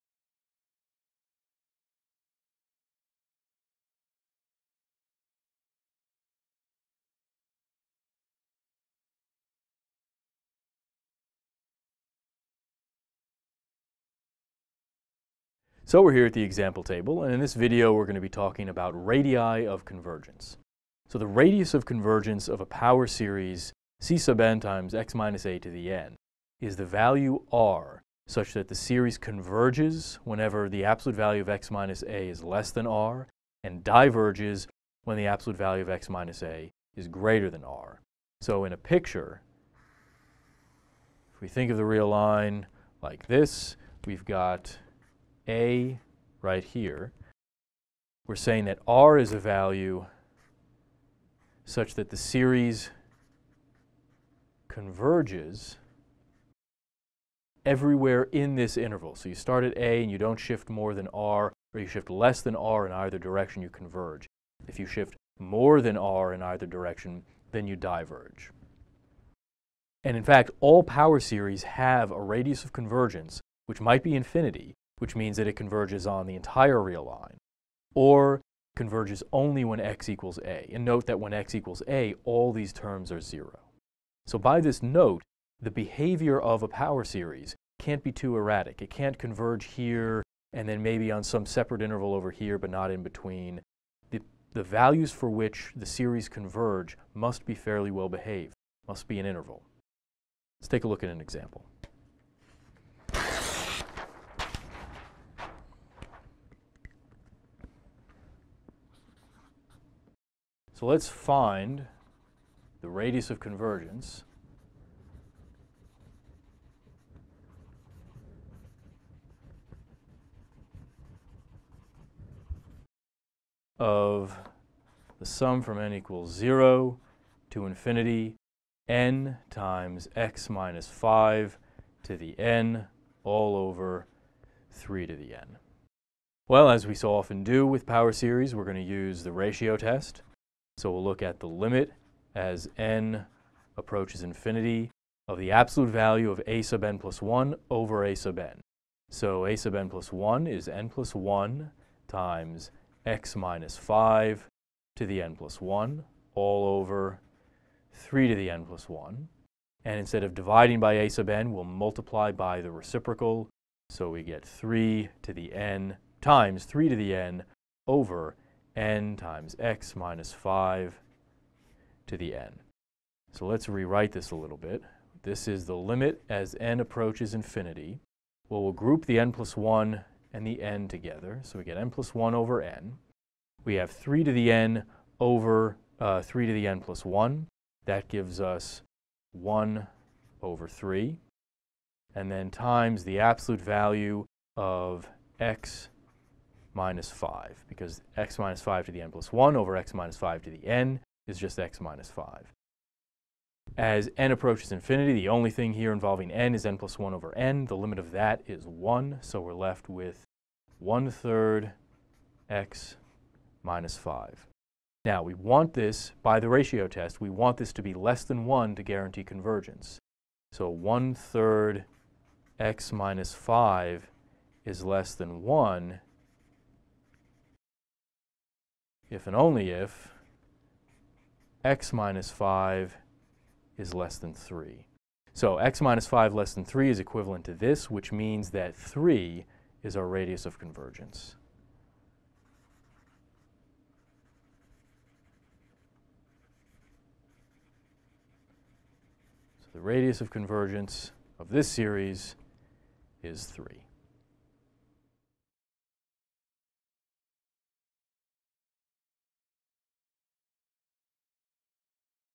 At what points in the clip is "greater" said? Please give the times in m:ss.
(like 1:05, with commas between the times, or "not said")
0:37.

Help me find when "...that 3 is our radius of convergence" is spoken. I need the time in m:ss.
3:58.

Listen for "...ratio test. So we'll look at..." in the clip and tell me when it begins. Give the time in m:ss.
2:19.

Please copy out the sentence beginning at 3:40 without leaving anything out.
So 1 third x minus 5 is less than 1 if and only if x minus 5 is less than 3.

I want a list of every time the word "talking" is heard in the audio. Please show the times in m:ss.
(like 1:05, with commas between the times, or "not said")
0:18.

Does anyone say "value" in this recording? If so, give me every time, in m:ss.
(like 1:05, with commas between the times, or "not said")
0:26, 0:31, 0:35, 0:49, 1:34, 2:25, 3:13.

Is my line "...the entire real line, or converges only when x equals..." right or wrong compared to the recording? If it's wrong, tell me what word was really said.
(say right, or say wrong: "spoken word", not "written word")
right.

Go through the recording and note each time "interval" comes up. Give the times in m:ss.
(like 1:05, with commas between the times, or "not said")
0:58, 1:31, 1:39.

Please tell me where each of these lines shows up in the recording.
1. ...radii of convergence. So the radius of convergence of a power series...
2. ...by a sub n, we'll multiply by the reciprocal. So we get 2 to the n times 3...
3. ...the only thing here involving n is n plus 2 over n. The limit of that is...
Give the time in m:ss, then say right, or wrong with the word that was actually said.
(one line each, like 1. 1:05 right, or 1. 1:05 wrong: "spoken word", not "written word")
1. 0:18 right
2. 2:40 wrong: "3", not "2"
3. 3:25 wrong: "1", not "2".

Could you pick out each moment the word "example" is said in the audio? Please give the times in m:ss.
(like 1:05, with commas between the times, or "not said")
0:16, 1:41.